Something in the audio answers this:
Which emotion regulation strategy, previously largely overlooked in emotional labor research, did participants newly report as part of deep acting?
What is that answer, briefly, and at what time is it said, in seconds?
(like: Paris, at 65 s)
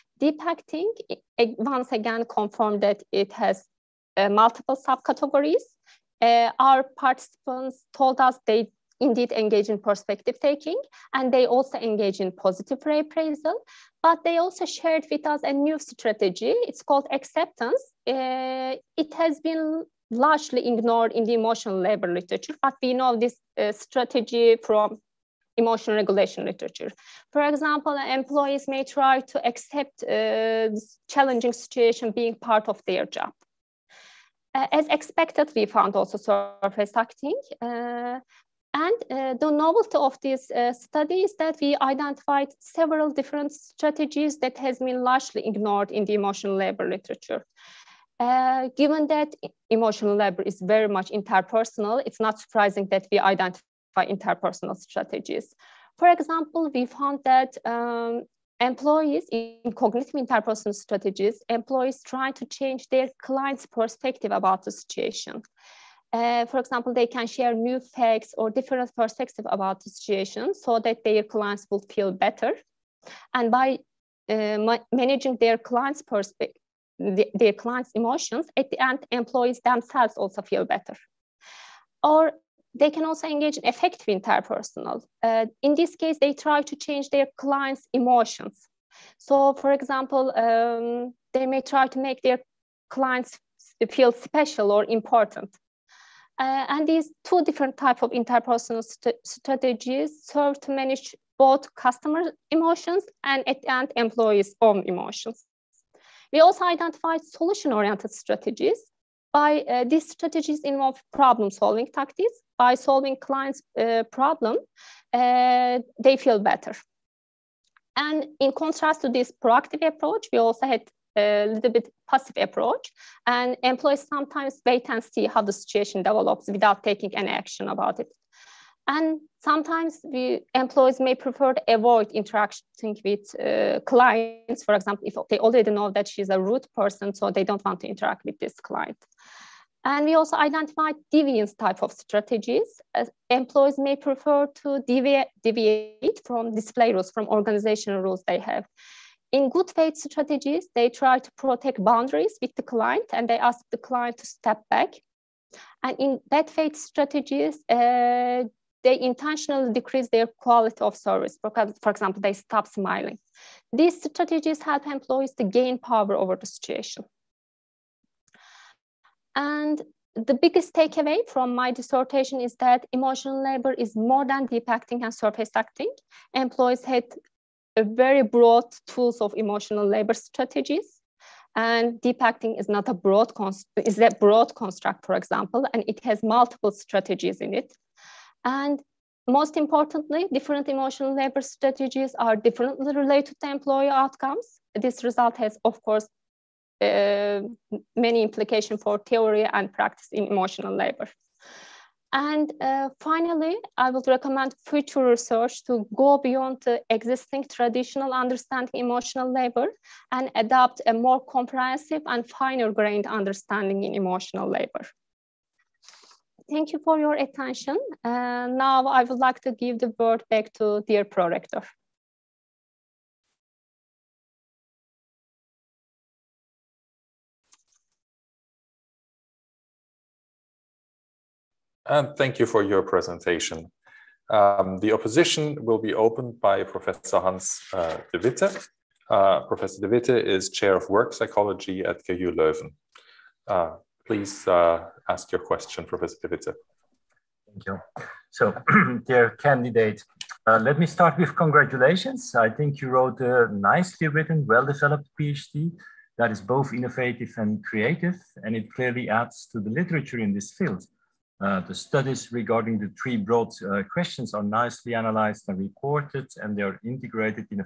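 Acceptance, at 17 s.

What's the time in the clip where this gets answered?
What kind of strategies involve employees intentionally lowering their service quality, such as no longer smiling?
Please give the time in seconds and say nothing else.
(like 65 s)
156 s.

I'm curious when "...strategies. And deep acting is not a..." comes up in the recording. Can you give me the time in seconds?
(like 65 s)
180 s.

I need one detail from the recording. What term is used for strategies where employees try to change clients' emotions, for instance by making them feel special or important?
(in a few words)
Affective interpersonal.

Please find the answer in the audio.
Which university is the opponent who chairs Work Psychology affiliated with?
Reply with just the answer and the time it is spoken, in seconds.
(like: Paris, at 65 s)
KU Leuven, at 242 s.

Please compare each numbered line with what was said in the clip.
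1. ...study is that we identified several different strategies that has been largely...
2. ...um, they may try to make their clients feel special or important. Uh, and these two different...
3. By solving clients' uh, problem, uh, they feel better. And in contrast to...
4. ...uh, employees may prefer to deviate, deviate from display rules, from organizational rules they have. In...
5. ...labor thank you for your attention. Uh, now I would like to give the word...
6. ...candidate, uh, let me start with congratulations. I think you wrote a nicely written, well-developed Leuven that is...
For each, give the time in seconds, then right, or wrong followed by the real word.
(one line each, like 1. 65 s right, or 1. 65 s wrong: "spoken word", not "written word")
1. 40 s right
2. 90 s right
3. 112 s right
4. 143 s right
5. 214 s right
6. 249 s wrong: "PhD", not "Leuven".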